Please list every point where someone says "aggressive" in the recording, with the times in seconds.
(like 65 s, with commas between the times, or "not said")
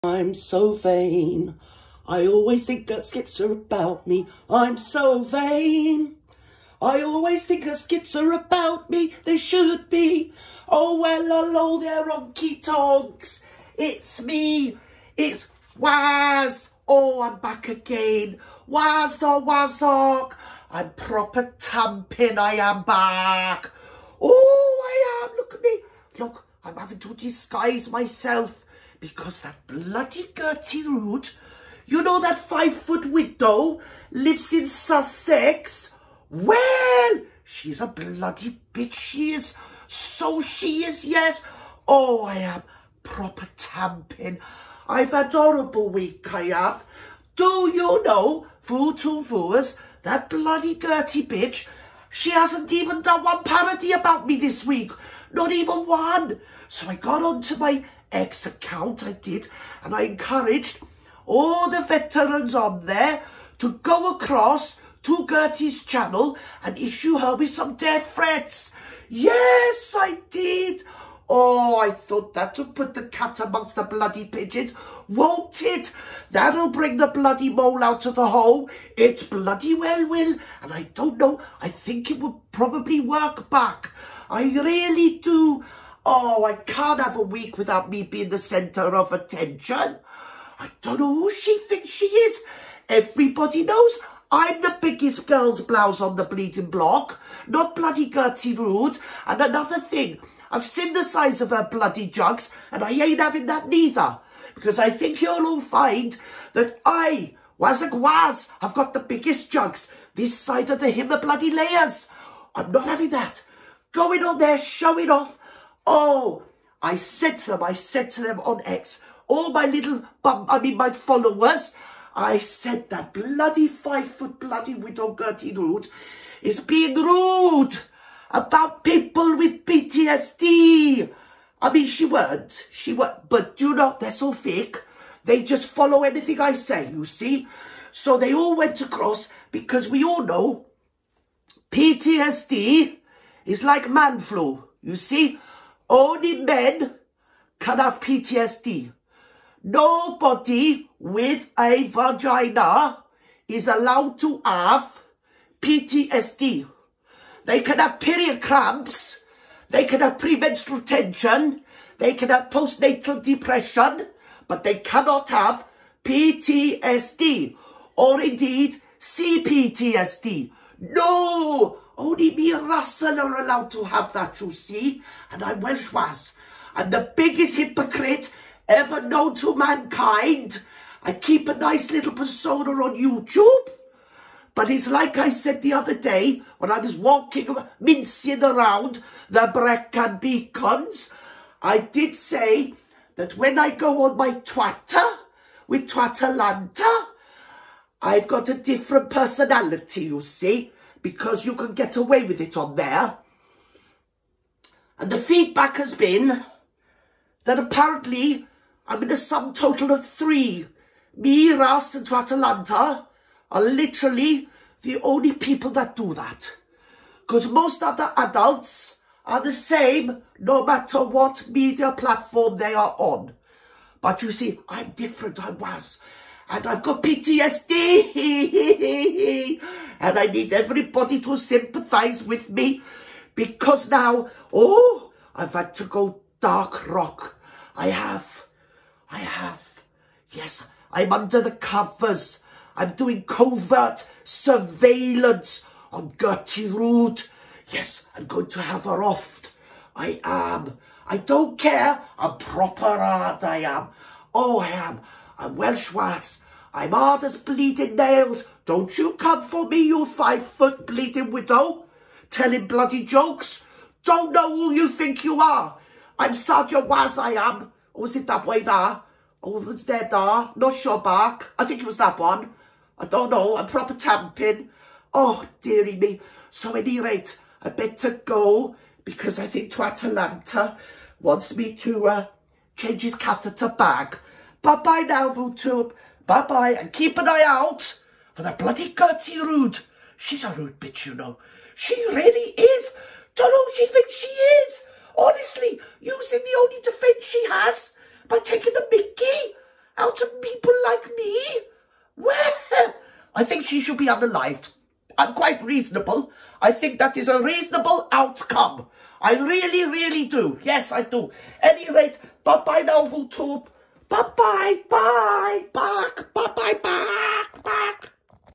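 not said.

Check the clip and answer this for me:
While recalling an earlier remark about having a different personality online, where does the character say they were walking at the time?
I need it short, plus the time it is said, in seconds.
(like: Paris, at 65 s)
Brecon Beacons, at 189 s.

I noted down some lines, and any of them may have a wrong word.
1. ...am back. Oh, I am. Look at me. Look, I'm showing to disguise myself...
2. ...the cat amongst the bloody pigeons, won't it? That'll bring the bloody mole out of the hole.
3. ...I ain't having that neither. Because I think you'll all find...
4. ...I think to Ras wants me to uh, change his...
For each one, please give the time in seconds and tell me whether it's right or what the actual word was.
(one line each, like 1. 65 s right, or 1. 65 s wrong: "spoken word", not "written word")
1. 22 s wrong: "having", not "showing"
2. 72 s right
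3. 102 s right
4. 279 s wrong: "Atalanta", not "Ras".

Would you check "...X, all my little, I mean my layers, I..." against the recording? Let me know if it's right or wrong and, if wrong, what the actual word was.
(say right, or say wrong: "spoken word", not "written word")
wrong: "followers", not "layers".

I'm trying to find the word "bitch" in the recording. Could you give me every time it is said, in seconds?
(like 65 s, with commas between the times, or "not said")
38 s, 51 s, 290 s.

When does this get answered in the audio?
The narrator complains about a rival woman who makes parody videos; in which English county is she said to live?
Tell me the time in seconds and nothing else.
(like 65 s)
34 s.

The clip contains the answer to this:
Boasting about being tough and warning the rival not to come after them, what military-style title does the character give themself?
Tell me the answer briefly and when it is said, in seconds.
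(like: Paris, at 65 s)
Sergeant Waz, at 266 s.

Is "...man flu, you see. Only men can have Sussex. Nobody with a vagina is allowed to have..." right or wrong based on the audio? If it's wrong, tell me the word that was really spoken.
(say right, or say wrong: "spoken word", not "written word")
wrong: "PTSD", not "Sussex".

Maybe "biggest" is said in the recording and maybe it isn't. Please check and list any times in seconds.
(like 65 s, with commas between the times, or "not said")
94 s, 108 s, 177 s.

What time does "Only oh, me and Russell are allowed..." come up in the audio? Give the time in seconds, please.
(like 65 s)
171 s.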